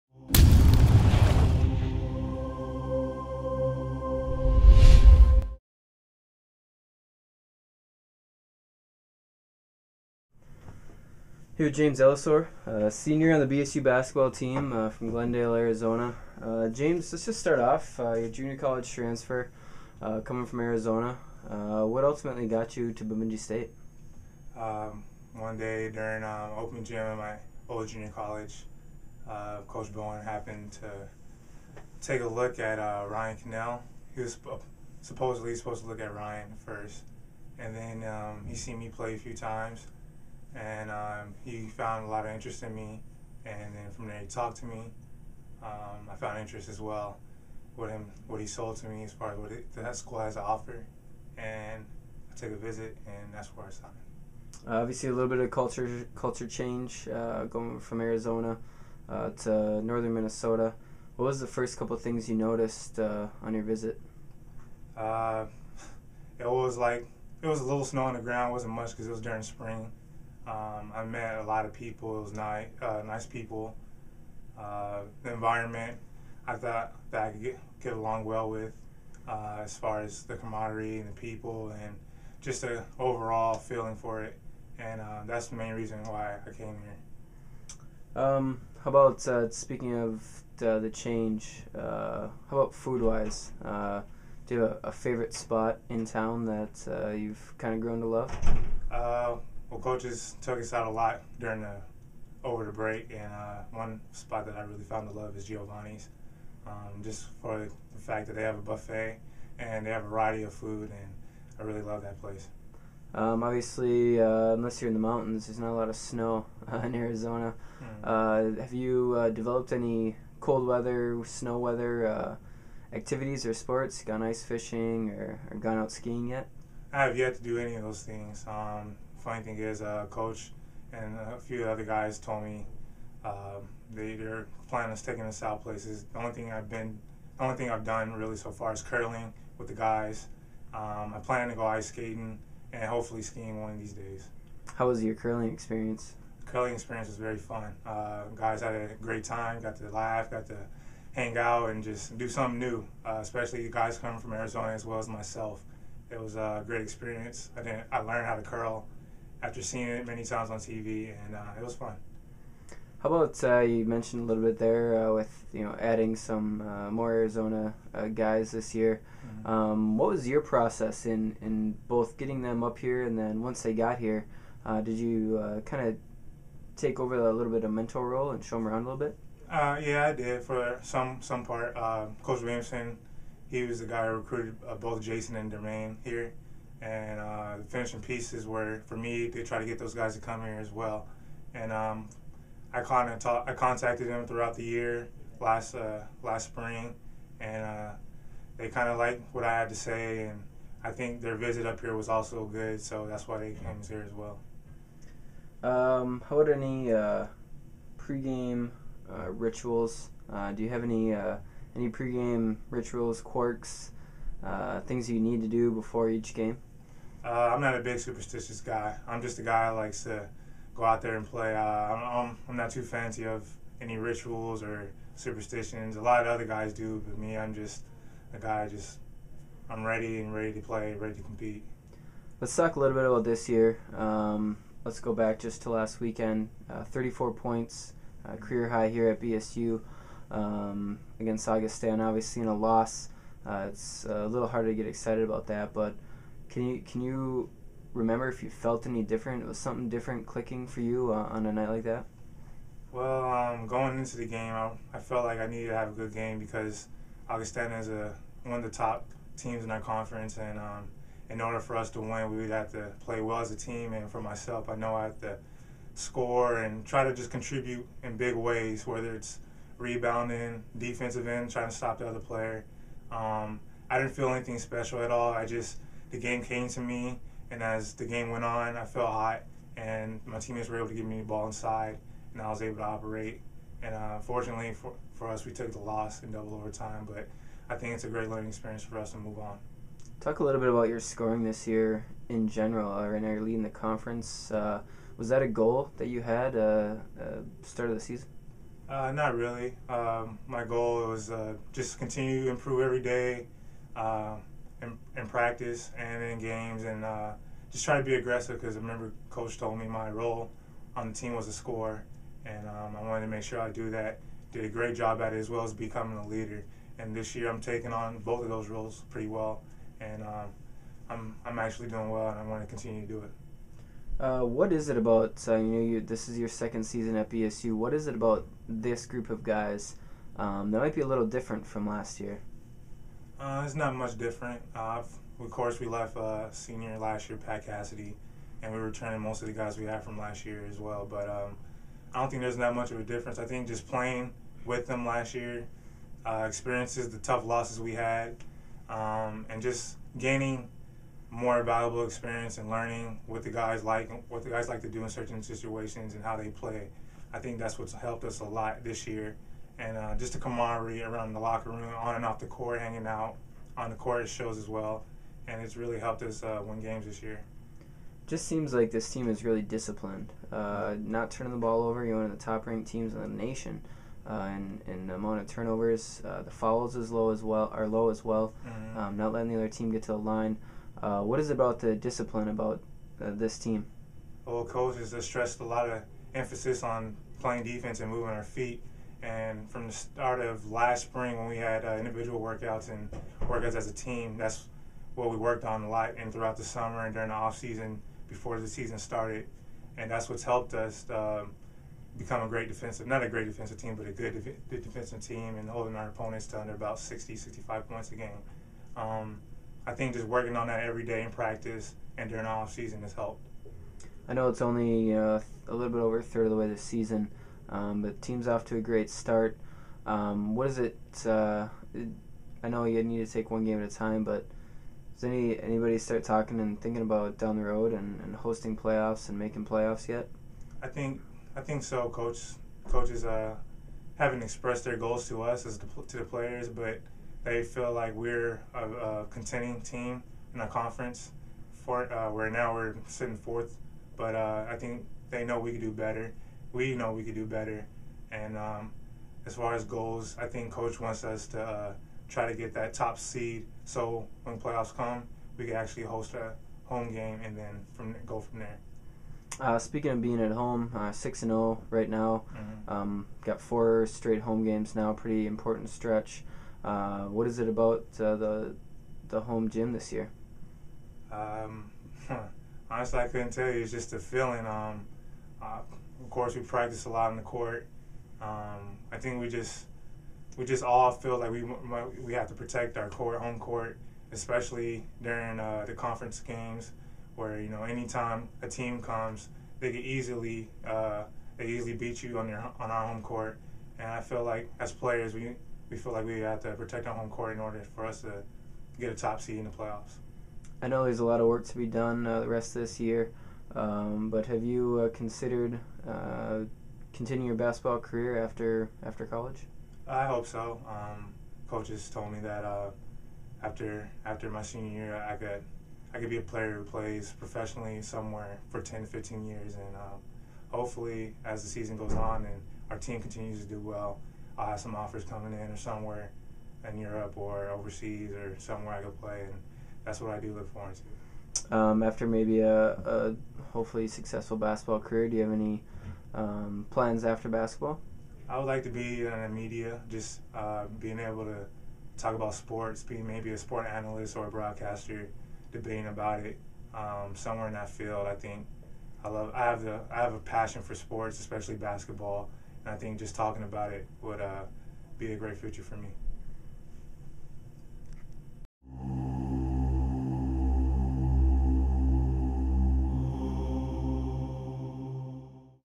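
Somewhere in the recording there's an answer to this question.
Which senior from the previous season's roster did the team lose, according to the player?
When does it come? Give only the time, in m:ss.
5:37.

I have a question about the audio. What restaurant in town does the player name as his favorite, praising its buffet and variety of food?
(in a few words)
Giovanni's.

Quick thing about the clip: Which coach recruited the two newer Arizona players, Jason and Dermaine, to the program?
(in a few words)
Coach Williamson.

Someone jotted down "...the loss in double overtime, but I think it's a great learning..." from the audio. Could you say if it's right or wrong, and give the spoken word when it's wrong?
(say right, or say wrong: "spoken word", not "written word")
right.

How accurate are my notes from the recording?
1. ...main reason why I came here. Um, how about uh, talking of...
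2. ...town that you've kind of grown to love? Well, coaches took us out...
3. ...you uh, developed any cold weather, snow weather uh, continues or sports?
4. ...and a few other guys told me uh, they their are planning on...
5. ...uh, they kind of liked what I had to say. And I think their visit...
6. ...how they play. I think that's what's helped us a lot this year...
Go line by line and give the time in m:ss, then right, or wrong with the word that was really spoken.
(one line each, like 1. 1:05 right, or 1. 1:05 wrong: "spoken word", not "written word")
1. 1:25 wrong: "speaking", not "talking"
2. 1:36 right
3. 1:58 wrong: "activities", not "continues"
4. 2:10 right
5. 3:17 right
6. 5:56 right.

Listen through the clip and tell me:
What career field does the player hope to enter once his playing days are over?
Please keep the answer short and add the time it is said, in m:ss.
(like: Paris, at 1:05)
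Media, at 8:59.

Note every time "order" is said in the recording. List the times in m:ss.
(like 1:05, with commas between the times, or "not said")
4:21, 8:17.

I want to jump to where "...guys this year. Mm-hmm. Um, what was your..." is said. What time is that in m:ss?
2:48.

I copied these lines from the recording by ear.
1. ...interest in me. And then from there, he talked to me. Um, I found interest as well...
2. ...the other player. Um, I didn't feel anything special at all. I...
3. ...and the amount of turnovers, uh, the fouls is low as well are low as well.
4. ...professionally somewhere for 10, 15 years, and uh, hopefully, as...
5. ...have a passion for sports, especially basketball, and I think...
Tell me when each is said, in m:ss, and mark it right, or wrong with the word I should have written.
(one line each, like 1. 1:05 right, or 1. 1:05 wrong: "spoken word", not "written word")
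1. 0:42 right
2. 4:31 right
3. 6:14 right
4. 8:37 right
5. 9:10 right.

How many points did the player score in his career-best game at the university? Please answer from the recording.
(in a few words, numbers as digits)
34.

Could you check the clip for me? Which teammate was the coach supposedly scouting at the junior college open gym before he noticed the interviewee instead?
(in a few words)
Ryan Cannell.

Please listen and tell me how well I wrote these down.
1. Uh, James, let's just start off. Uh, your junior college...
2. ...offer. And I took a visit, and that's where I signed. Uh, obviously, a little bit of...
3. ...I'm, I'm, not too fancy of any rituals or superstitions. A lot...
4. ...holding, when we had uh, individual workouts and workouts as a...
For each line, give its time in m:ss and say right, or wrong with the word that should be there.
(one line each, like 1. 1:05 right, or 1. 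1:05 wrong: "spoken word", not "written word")
1. 0:16 right
2. 0:50 right
3. 3:41 right
4. 6:31 wrong: "spring", not "holding".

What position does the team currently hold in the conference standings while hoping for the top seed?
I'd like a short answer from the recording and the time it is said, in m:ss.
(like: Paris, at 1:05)
Fourth, at 7:23.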